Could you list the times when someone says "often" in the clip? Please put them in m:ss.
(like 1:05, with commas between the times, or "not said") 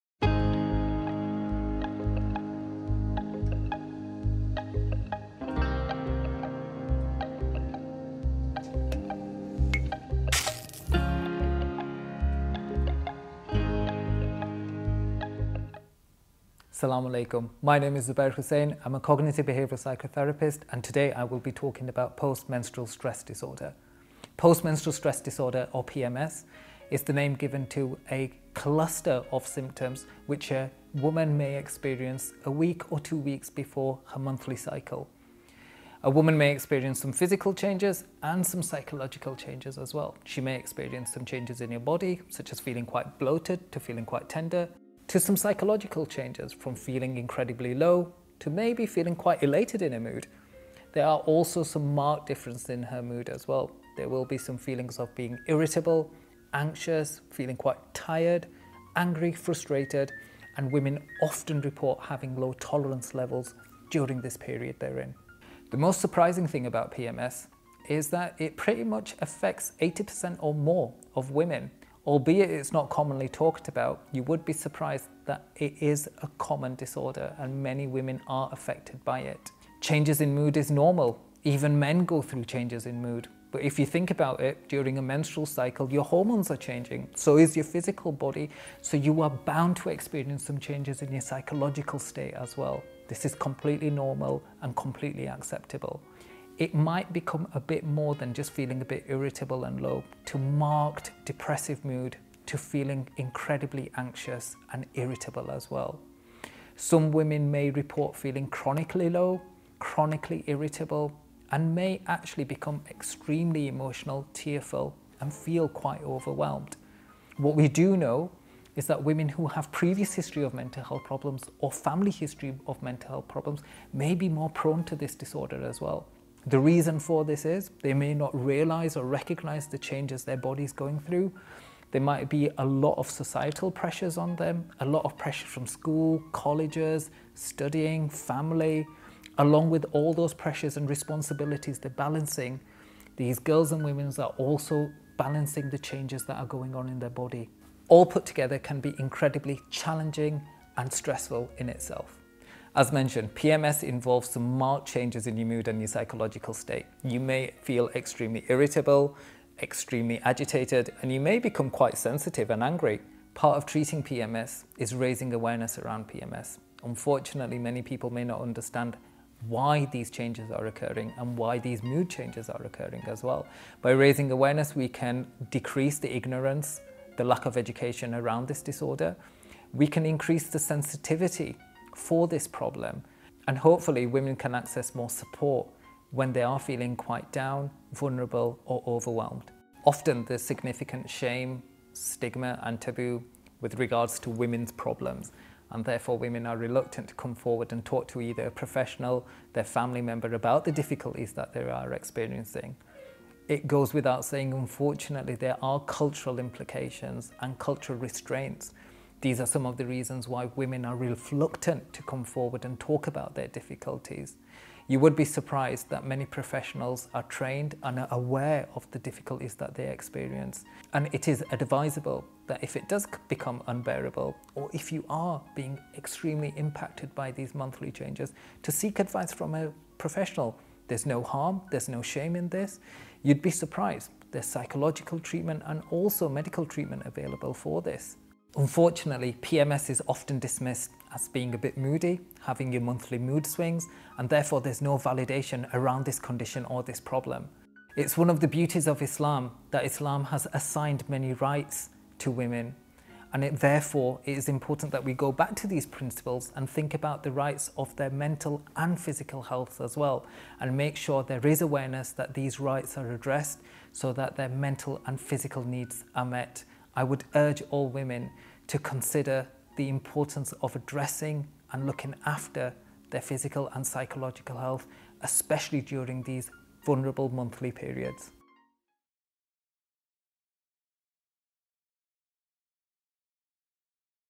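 1:01, 3:09, 4:00.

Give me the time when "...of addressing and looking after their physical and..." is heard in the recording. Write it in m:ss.
4:30.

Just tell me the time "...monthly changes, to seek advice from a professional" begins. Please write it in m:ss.
3:47.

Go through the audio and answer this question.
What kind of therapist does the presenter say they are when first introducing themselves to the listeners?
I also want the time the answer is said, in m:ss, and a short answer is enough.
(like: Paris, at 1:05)
Cognitive behavioral psychotherapist, at 0:18.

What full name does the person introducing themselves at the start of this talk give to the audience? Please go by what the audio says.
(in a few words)
Zubeir Hussain.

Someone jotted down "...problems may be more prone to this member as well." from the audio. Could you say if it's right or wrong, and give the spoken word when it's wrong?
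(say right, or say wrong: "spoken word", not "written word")
wrong: "disorder", not "member".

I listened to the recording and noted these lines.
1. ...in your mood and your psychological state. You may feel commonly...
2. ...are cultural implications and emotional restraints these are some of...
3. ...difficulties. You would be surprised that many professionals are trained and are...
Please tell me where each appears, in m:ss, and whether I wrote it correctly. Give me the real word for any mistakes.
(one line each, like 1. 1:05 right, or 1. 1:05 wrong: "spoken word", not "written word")
1. 2:35 wrong: "extremely", not "commonly"
2. 3:25 wrong: "cultural", not "emotional"
3. 3:33 right.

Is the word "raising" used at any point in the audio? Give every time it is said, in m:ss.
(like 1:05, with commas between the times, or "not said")
2:44, 2:53.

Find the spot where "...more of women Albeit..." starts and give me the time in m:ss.
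1:10.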